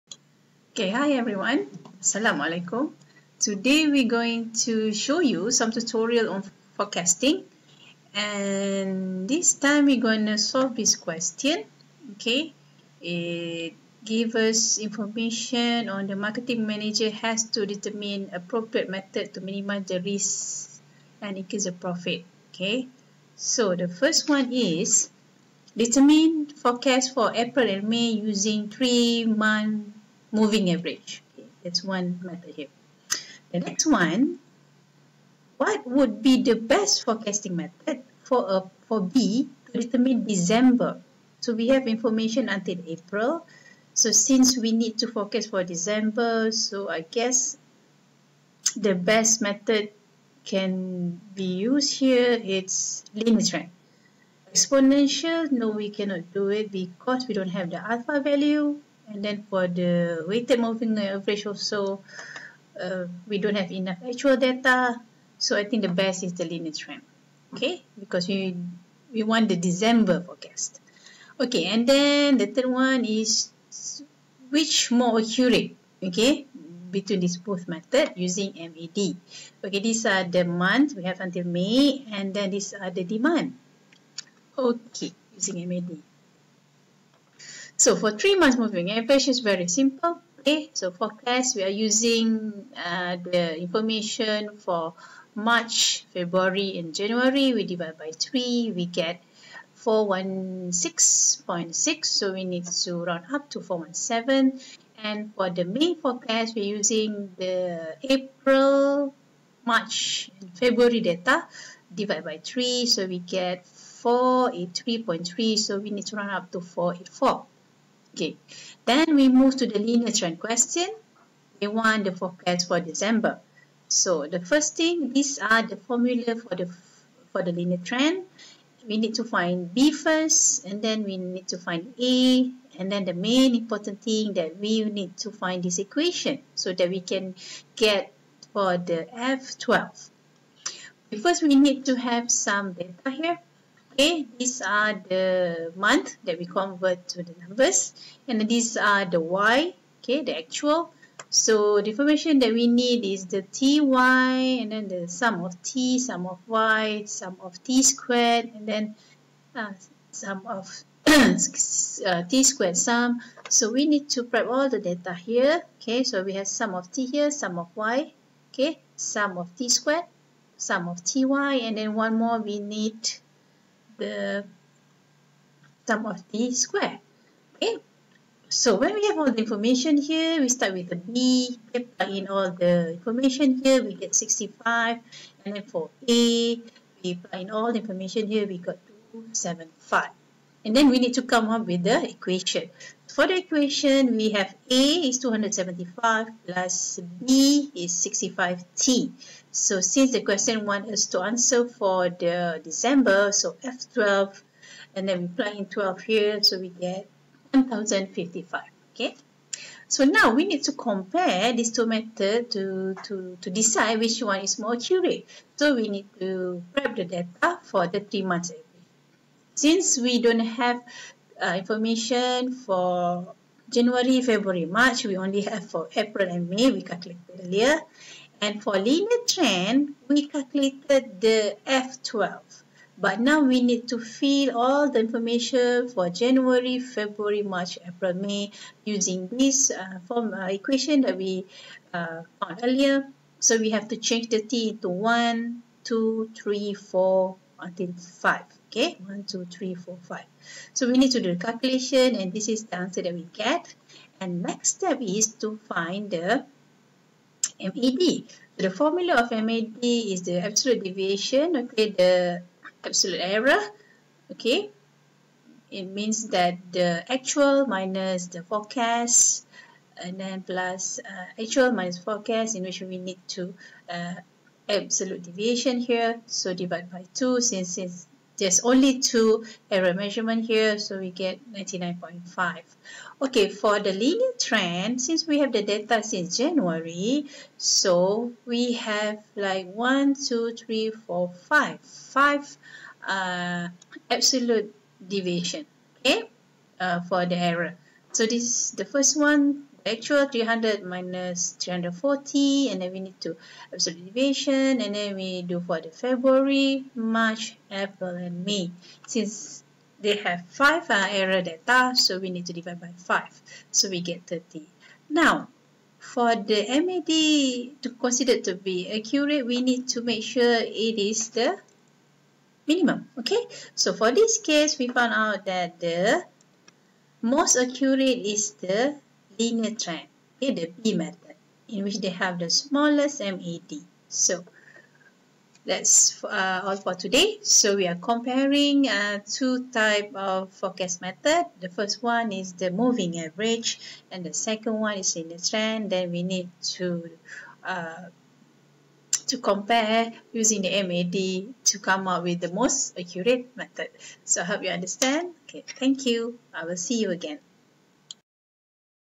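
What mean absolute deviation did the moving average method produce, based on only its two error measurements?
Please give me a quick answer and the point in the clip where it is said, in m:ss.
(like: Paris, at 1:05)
99.5, at 4:41.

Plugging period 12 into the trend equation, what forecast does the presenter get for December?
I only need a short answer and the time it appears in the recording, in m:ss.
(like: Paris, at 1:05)
1055, at 3:27.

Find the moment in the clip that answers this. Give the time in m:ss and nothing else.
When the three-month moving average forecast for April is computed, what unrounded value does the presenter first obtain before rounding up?
1:39.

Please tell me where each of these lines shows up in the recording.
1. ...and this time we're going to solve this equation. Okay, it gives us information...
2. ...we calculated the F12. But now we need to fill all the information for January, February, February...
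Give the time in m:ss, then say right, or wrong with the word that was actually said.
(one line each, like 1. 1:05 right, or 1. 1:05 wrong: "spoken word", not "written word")
1. 0:08 wrong: "question", not "equation"
2. 3:50 wrong: "March", not "February".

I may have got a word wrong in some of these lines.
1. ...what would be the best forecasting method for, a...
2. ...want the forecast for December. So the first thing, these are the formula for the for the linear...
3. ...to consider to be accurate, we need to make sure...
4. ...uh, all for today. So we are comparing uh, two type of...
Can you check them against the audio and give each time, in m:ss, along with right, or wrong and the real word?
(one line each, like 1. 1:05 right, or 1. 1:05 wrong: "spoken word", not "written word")
1. 0:35 right
2. 2:01 right
3. 5:17 right
4. 5:36 right.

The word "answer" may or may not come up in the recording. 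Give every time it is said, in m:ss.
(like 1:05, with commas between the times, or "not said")
3:21, 4:12.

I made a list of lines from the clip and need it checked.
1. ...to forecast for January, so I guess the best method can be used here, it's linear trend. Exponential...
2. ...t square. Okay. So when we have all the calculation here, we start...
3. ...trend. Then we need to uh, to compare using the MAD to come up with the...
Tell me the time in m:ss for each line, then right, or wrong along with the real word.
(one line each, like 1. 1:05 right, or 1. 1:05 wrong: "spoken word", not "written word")
1. 0:44 wrong: "December", not "January"
2. 2:56 wrong: "information", not "calculation"
3. 5:45 right.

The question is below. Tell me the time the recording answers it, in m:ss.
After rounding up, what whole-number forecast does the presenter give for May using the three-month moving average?
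1:56.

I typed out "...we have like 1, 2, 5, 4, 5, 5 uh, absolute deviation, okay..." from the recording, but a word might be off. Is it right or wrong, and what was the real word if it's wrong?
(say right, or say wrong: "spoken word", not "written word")
wrong: "3", not "5".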